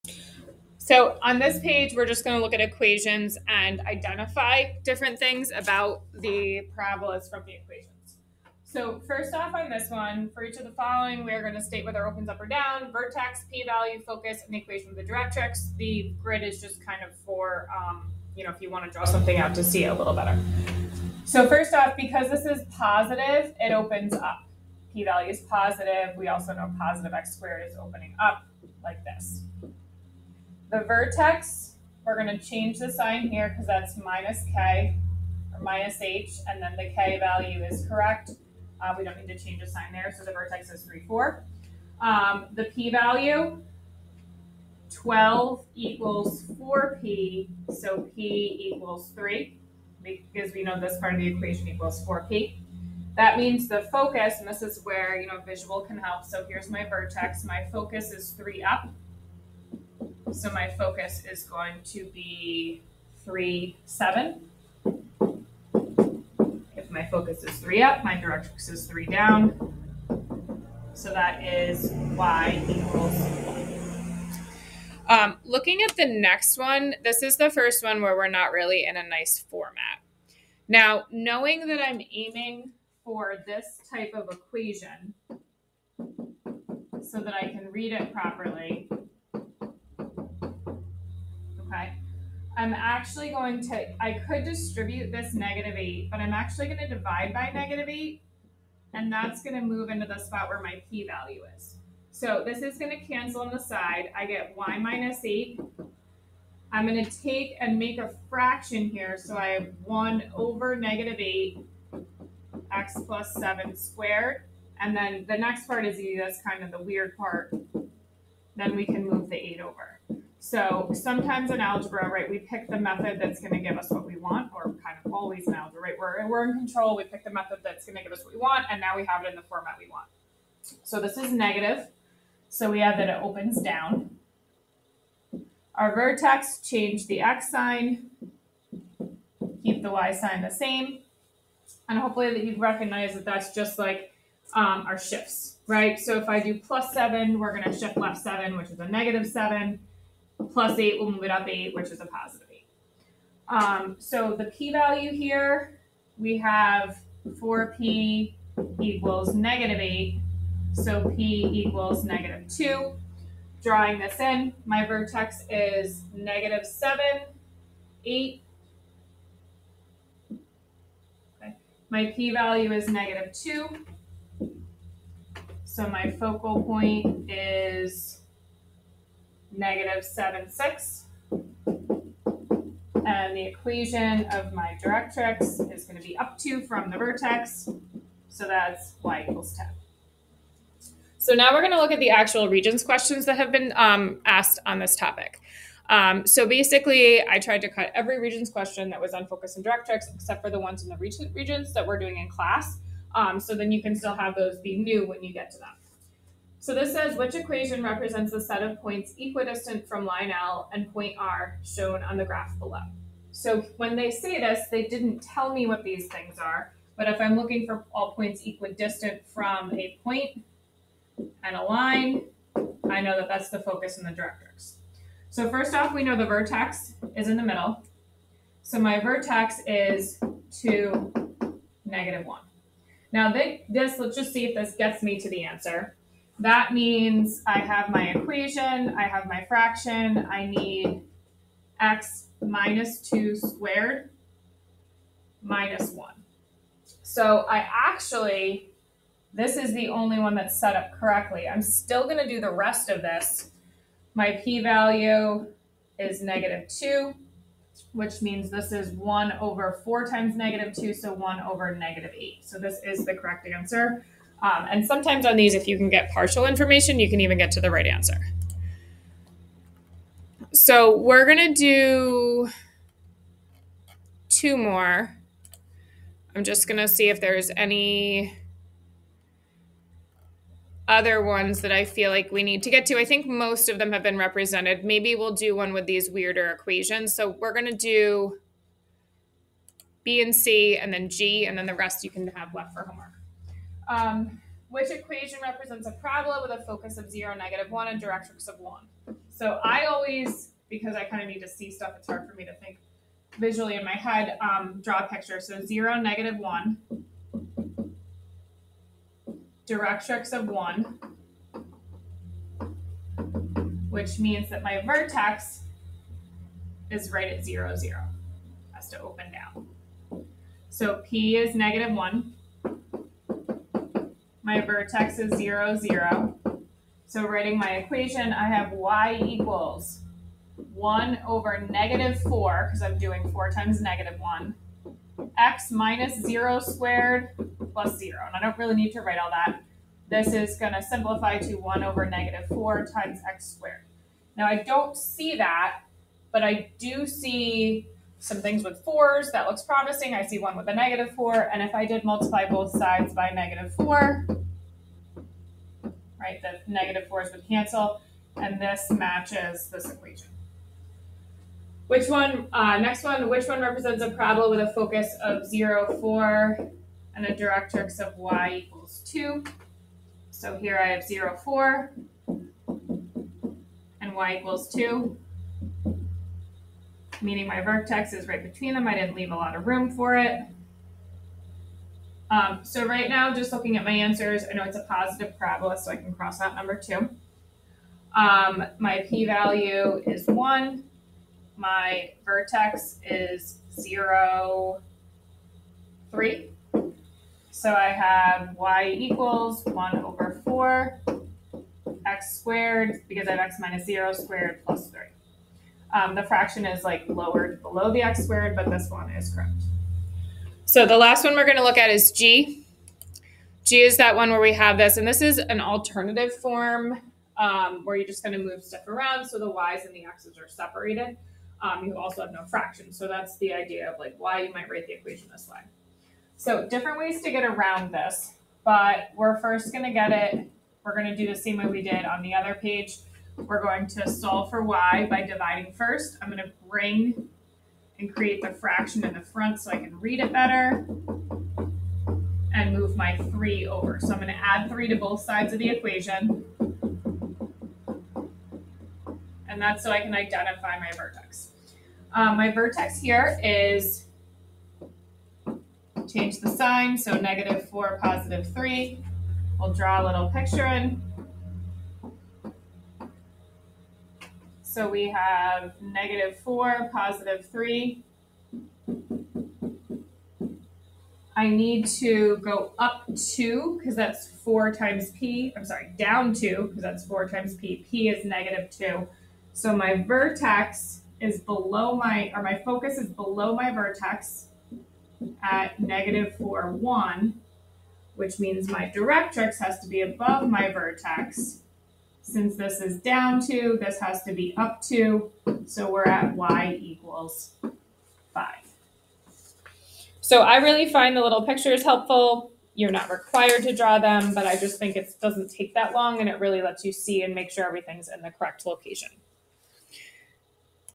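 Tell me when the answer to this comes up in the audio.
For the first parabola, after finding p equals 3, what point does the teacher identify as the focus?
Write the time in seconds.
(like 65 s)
63 s.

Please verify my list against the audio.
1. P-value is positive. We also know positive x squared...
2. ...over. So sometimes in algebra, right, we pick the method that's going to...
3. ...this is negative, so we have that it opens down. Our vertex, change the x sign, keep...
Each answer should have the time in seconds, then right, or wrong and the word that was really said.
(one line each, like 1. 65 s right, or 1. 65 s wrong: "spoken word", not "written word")
1. 24 s right
2. 119 s right
3. 130 s right.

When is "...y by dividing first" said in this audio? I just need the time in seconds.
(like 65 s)
434 s.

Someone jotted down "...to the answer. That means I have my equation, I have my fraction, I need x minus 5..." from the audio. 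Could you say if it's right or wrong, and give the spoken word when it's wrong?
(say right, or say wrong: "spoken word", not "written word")
wrong: "2", not "5".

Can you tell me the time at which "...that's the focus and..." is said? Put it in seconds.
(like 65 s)
223 s.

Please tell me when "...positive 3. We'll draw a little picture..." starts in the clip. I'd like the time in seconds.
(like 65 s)
458 s.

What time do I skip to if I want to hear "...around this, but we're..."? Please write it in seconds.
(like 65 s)
427 s.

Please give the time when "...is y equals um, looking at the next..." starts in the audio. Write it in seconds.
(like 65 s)
71 s.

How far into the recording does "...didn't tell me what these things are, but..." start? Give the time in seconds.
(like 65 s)
214 s.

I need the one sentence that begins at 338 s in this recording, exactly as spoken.
And I don't really need to write all that.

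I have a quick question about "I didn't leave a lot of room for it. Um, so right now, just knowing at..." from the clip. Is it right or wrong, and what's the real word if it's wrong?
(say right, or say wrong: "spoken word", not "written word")
wrong: "looking", not "knowing".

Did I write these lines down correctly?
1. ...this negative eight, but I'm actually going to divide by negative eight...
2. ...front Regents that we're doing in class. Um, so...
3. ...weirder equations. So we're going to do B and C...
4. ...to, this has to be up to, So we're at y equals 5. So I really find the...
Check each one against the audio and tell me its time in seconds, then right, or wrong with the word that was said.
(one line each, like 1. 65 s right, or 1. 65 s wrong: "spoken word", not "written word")
1. 95 s right
2. 200 s wrong: "recent", not "front"
3. 286 s right
4. 493 s right.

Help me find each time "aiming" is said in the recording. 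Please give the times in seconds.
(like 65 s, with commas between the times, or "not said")
82 s.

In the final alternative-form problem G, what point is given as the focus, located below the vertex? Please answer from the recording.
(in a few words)
(-4, 1).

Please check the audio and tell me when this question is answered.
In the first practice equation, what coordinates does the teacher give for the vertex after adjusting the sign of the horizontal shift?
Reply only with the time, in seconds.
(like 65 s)
40 s.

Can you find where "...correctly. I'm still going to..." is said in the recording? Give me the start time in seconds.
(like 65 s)
250 s.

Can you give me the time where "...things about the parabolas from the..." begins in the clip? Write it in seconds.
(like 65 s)
5 s.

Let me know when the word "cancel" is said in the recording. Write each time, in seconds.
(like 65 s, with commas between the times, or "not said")
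103 s, 357 s.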